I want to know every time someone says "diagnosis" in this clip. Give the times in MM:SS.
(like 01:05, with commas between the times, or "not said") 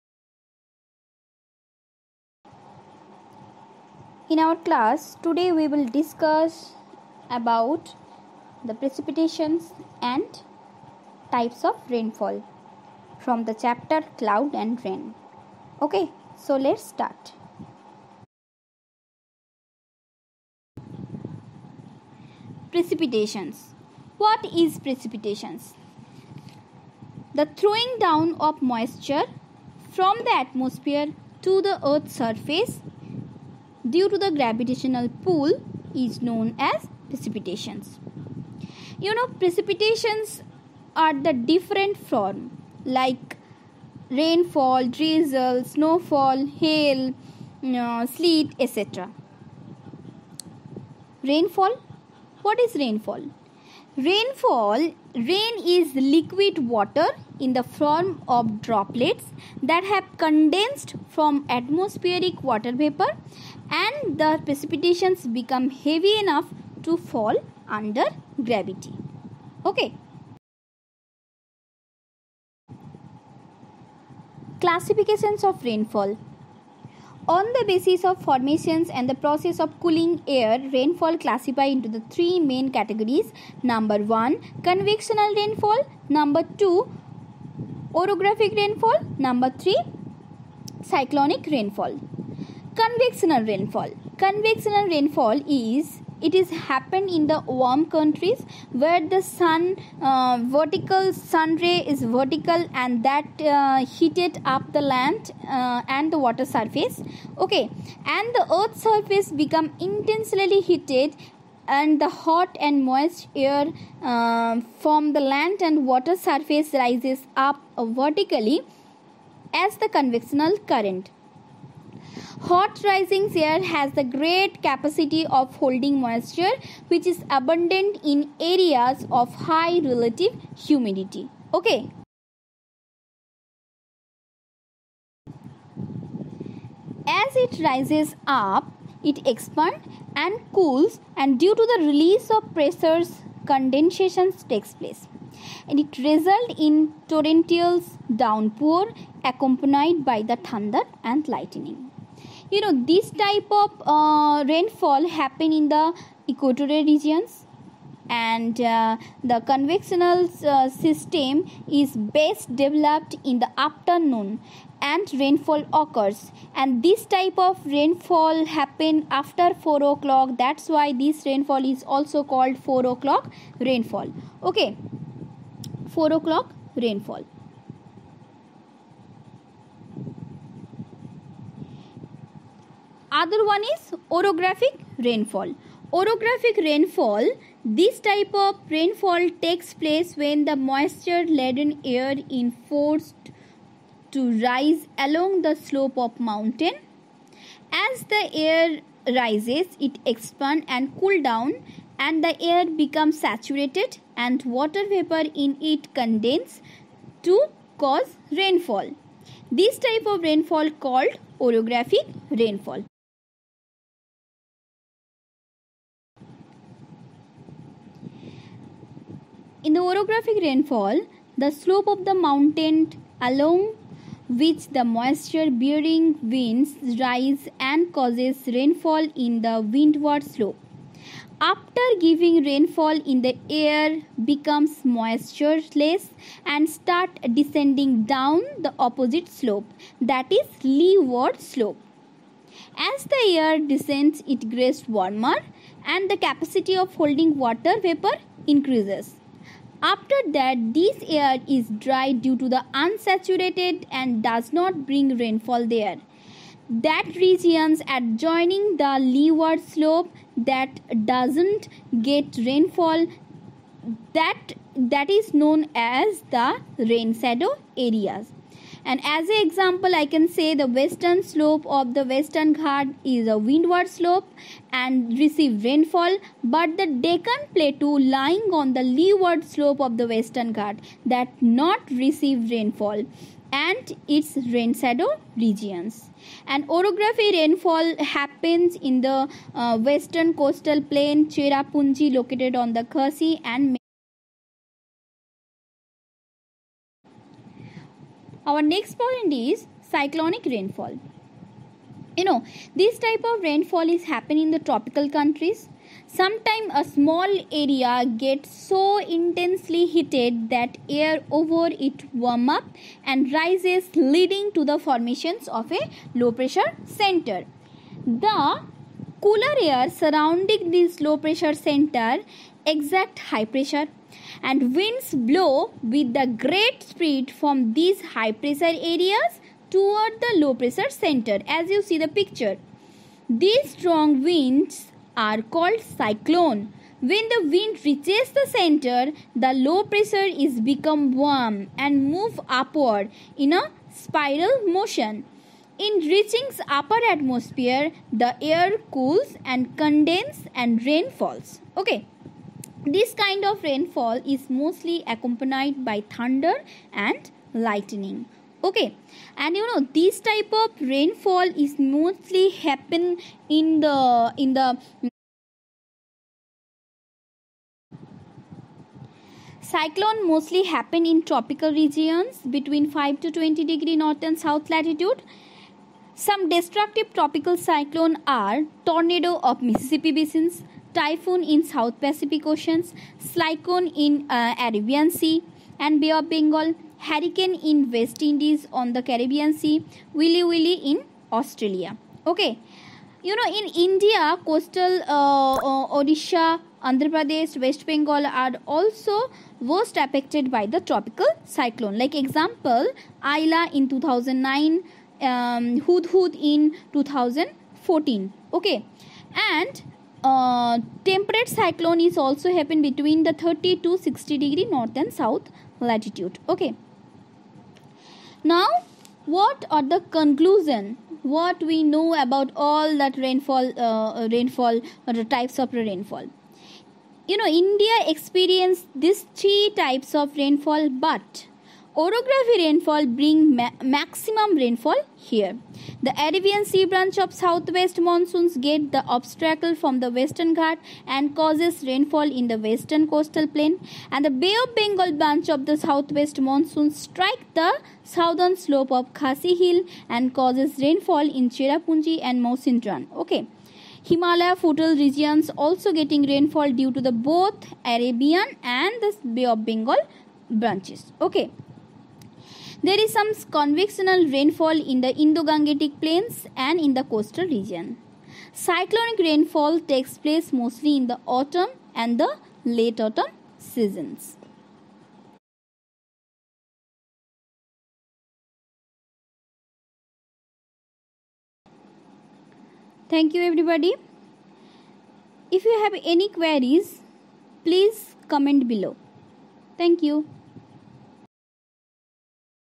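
not said.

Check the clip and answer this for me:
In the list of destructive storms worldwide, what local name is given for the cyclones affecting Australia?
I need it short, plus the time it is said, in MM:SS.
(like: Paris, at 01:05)
Willy willy, at 06:30.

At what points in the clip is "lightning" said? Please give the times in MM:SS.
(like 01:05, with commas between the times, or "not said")
02:31, 05:57.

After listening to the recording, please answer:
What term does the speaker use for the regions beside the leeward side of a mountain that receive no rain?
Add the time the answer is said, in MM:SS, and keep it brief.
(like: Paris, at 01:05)
Rain shadow areas, at 04:26.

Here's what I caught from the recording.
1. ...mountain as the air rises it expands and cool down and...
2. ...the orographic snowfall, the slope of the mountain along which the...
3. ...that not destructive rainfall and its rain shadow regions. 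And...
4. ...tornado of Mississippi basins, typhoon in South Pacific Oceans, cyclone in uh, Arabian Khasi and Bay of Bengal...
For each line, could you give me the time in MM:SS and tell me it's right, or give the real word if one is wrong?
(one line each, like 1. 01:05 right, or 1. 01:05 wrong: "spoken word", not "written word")
1. 03:16 right
2. 03:39 wrong: "rainfall", not "snowfall"
3. 04:41 wrong: "receive", not "destructive"
4. 06:18 wrong: "Sea", not "Khasi".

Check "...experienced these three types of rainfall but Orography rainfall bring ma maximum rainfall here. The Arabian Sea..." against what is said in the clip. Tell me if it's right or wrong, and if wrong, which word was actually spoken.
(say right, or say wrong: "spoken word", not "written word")
right.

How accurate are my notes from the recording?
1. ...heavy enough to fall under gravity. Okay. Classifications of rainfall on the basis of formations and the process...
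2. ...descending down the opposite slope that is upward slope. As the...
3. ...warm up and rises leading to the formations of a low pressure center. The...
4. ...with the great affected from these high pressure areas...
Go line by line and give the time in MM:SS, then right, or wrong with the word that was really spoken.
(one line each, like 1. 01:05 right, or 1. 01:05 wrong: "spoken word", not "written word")
1. 01:05 right
2. 03:57 wrong: "leeward", not "upward"
3. 05:12 right
4. 05:25 wrong: "speed", not "affected".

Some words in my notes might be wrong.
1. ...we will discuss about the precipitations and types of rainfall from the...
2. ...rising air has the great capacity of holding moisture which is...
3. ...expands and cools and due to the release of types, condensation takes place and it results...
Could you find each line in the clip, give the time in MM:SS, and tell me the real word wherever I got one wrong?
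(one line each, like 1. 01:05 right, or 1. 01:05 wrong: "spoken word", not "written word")
1. 00:05 right
2. 02:02 right
3. 02:19 wrong: "pressures", not "types".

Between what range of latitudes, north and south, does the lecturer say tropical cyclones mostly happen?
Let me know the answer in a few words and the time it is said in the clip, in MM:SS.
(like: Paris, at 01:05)
5 to 20 degrees, at 06:12.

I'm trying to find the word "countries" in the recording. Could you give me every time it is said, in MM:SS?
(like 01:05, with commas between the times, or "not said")
01:37, 05:05.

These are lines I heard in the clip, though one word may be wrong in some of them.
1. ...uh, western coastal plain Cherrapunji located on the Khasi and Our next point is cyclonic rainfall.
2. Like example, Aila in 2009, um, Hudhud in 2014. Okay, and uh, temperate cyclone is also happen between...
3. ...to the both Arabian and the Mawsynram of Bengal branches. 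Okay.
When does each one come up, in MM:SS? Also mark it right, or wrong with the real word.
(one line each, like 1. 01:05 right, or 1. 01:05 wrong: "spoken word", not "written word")
1. 04:49 right
2. 06:41 right
3. 07:36 wrong: "Bay", not "Mawsynram".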